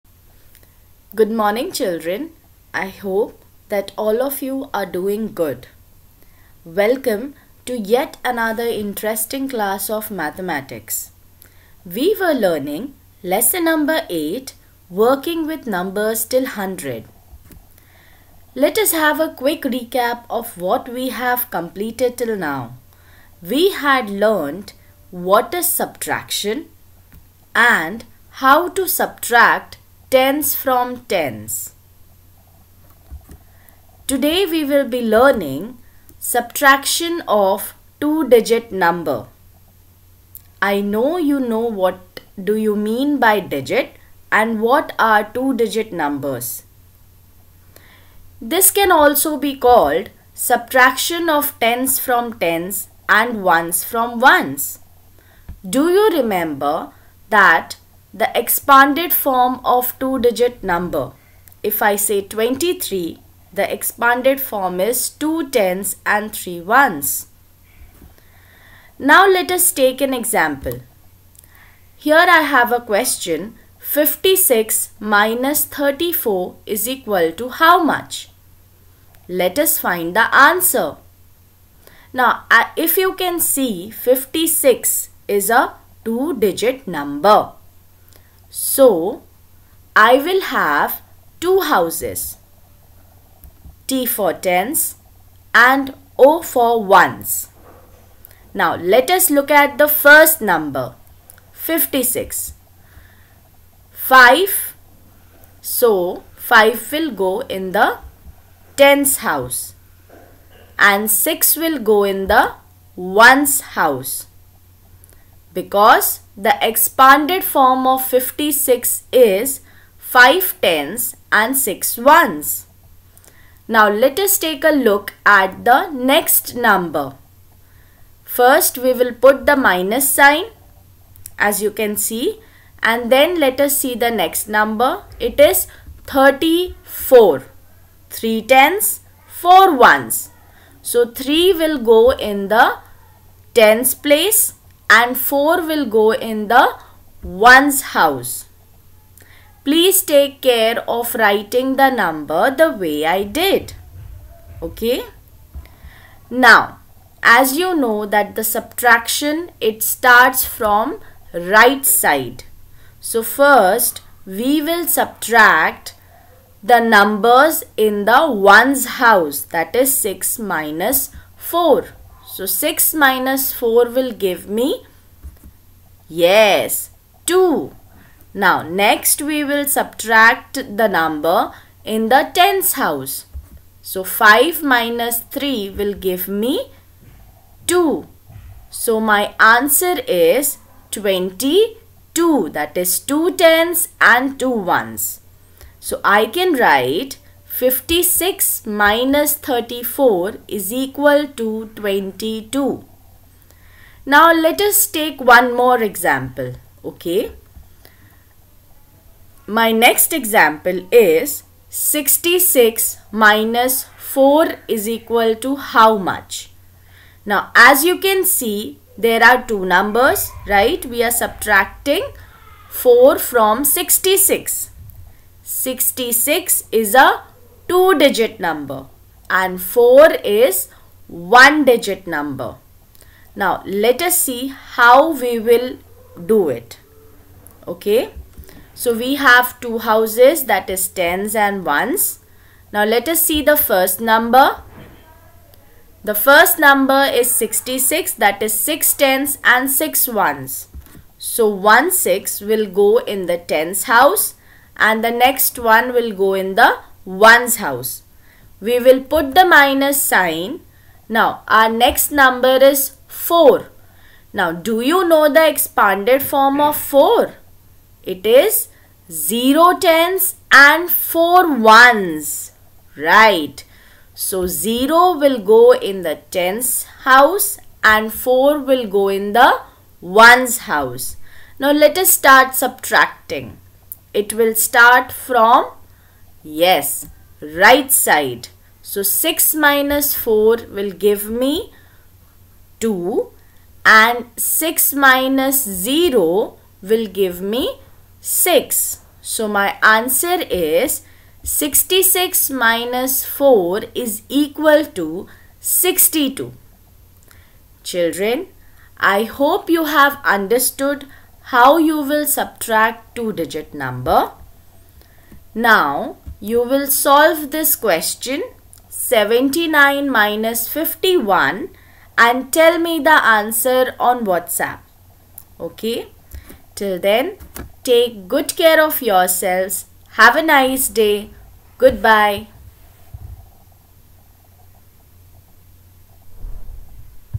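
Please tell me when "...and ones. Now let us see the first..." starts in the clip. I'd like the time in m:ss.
4:01.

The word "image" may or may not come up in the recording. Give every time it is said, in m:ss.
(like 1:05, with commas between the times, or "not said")
not said.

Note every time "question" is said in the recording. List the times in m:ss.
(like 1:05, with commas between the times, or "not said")
1:12, 5:17.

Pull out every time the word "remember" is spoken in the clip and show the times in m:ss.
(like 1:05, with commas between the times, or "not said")
0:56.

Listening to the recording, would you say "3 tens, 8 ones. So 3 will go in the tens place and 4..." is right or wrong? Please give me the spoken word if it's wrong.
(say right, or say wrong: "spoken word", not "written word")
wrong: "4", not "8".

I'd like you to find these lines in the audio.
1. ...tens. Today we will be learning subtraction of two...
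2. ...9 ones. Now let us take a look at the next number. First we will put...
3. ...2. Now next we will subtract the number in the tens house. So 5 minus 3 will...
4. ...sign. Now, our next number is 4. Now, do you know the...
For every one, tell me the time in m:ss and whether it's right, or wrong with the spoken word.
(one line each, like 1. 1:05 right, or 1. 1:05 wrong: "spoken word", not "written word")
1. 0:31 right
2. 2:01 wrong: "6", not "9"
3. 2:57 right
4. 4:20 right.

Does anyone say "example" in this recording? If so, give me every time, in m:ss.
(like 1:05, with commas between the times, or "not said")
1:10, 3:25, 3:30.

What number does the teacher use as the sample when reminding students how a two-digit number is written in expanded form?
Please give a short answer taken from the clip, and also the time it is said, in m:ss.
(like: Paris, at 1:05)
23, at 1:02.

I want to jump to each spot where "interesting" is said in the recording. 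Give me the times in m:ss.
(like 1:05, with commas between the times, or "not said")
0:08.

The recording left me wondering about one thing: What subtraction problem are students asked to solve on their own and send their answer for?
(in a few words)
79 minus 51.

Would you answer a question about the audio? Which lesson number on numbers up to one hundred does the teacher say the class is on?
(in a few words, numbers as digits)
8.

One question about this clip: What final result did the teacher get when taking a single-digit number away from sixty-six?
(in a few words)
62.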